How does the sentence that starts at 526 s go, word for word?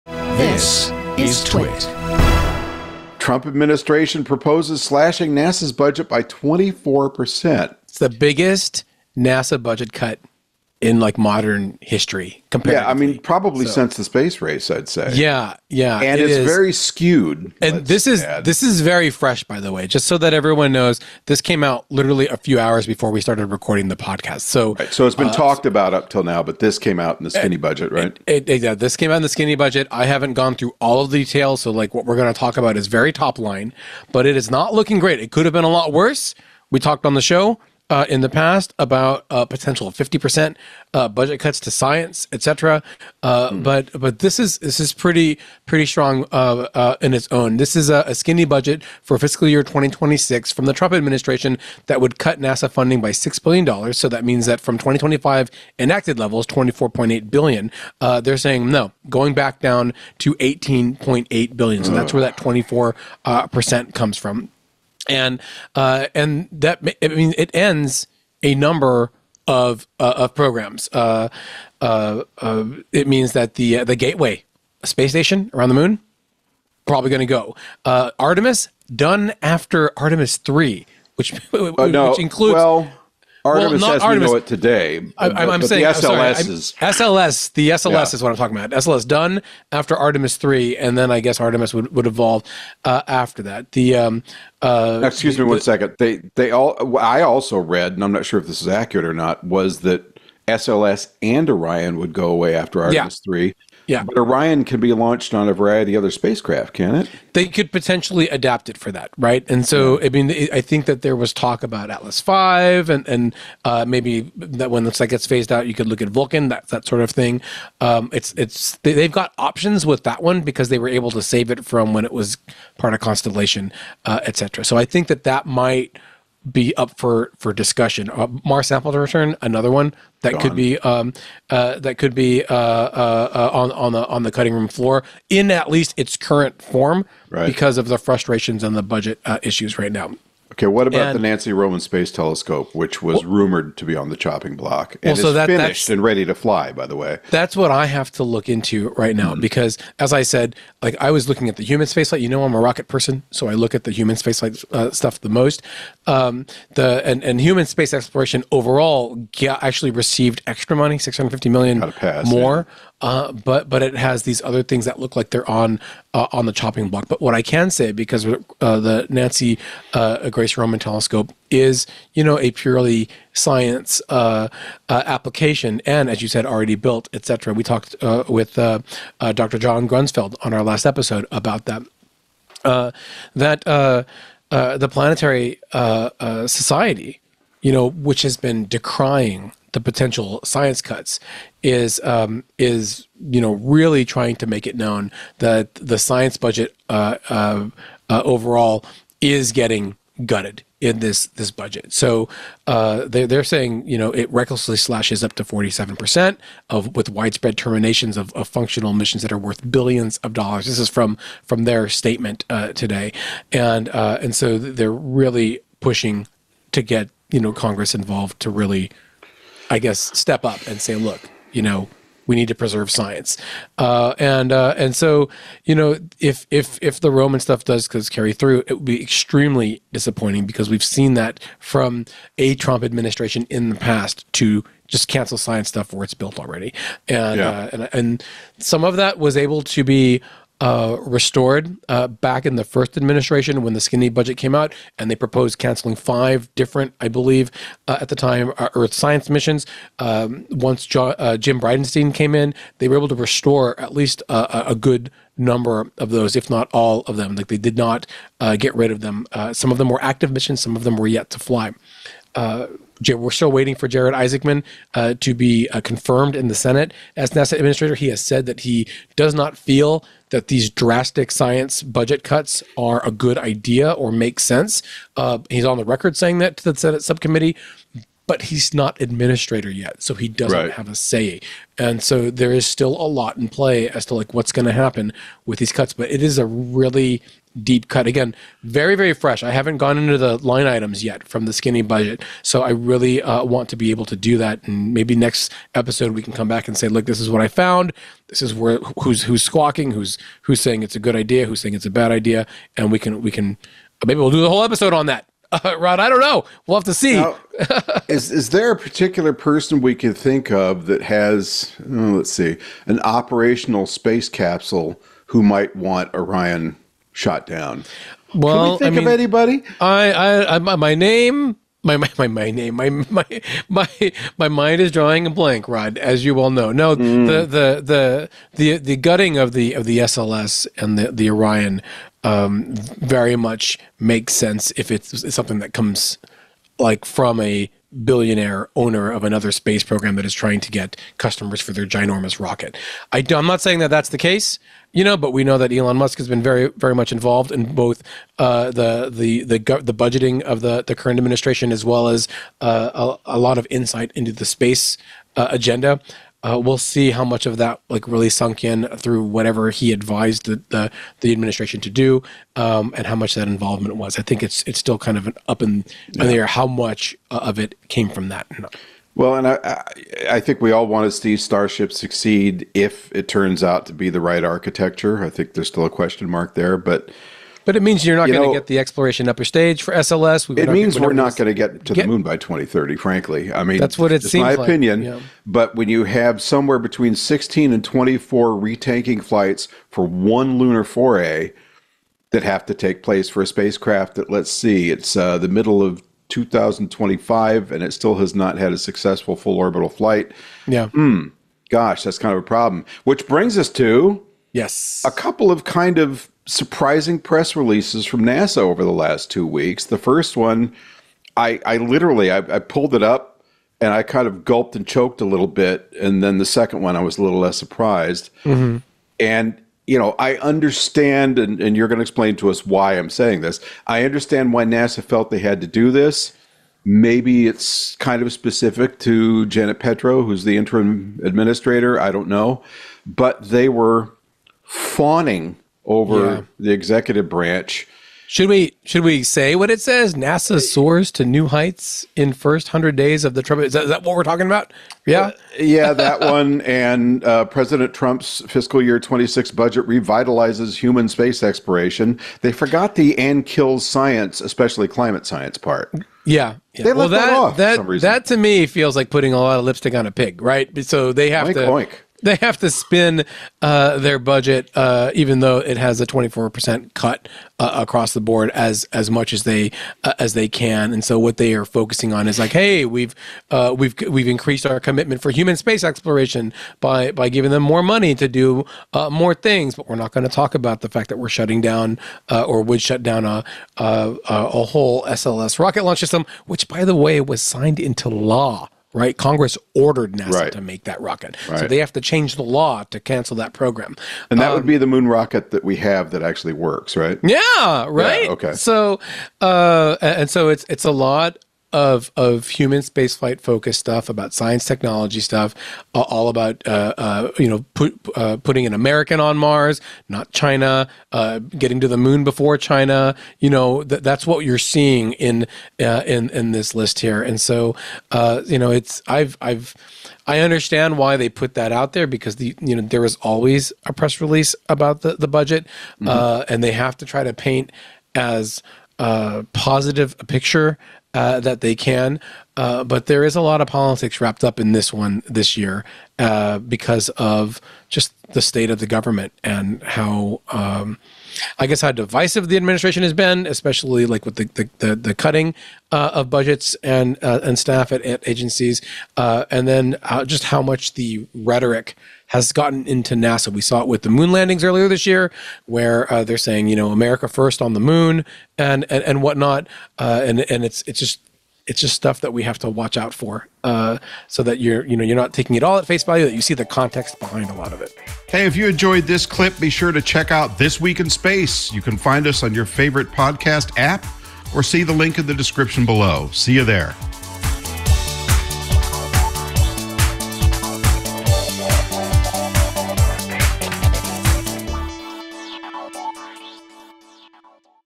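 and they have to try to paint as uh, positive a picture uh, that they can.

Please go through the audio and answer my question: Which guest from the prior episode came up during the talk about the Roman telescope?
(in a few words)
John Grunsfeld.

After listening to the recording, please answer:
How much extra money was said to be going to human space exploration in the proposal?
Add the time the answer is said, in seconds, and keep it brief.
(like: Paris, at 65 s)
650 million, at 160 s.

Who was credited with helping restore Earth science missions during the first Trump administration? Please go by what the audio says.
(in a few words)
Jim Bridenstine.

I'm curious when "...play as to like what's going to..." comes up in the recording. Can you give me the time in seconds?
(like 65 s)
283 s.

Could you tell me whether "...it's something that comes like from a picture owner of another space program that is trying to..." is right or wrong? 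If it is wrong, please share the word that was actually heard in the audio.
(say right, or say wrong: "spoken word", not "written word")
wrong: "billionaire", not "picture".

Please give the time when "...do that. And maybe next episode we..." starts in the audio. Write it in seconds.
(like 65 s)
294 s.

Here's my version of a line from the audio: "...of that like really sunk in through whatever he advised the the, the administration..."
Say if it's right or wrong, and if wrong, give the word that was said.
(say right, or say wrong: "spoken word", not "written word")
right.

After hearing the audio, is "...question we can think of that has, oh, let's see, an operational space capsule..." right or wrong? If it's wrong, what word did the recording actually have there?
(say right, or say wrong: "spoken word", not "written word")
wrong: "person", not "question".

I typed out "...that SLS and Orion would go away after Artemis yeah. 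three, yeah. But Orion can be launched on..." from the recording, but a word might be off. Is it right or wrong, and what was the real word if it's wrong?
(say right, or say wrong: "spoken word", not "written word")
right.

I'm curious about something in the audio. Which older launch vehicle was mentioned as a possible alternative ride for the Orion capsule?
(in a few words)
Atlas V.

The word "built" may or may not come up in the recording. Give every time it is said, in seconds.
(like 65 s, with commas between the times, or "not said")
176 s, 236 s.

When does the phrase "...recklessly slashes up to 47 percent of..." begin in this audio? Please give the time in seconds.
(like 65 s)
204 s.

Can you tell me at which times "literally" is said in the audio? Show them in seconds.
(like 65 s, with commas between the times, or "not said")
21 s, 411 s.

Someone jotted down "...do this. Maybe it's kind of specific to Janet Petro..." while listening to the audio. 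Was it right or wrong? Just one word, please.
right.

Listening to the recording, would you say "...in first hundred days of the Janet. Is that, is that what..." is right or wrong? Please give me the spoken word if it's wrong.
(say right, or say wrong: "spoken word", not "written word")
wrong: "Trump", not "Janet".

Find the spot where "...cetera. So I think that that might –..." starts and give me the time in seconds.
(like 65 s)
124 s.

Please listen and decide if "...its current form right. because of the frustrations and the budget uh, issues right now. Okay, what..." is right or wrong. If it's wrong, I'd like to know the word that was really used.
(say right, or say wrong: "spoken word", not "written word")
right.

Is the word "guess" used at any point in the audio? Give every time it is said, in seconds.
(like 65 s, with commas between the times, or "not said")
91 s, 219 s, 541 s.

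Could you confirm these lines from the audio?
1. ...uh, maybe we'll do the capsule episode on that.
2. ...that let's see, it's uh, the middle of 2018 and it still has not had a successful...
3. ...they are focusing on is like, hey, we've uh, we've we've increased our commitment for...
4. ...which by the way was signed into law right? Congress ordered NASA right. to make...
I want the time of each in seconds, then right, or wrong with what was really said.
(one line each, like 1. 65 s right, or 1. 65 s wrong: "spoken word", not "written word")
1. 304 s wrong: "whole", not "capsule"
2. 394 s wrong: "2025", not "2018"
3. 471 s right
4. 486 s right.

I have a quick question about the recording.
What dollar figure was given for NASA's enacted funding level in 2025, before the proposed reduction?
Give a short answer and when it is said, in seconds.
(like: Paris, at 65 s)
24.8 billion, at 56 s.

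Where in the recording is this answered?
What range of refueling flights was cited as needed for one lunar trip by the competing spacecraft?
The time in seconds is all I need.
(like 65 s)
387 s.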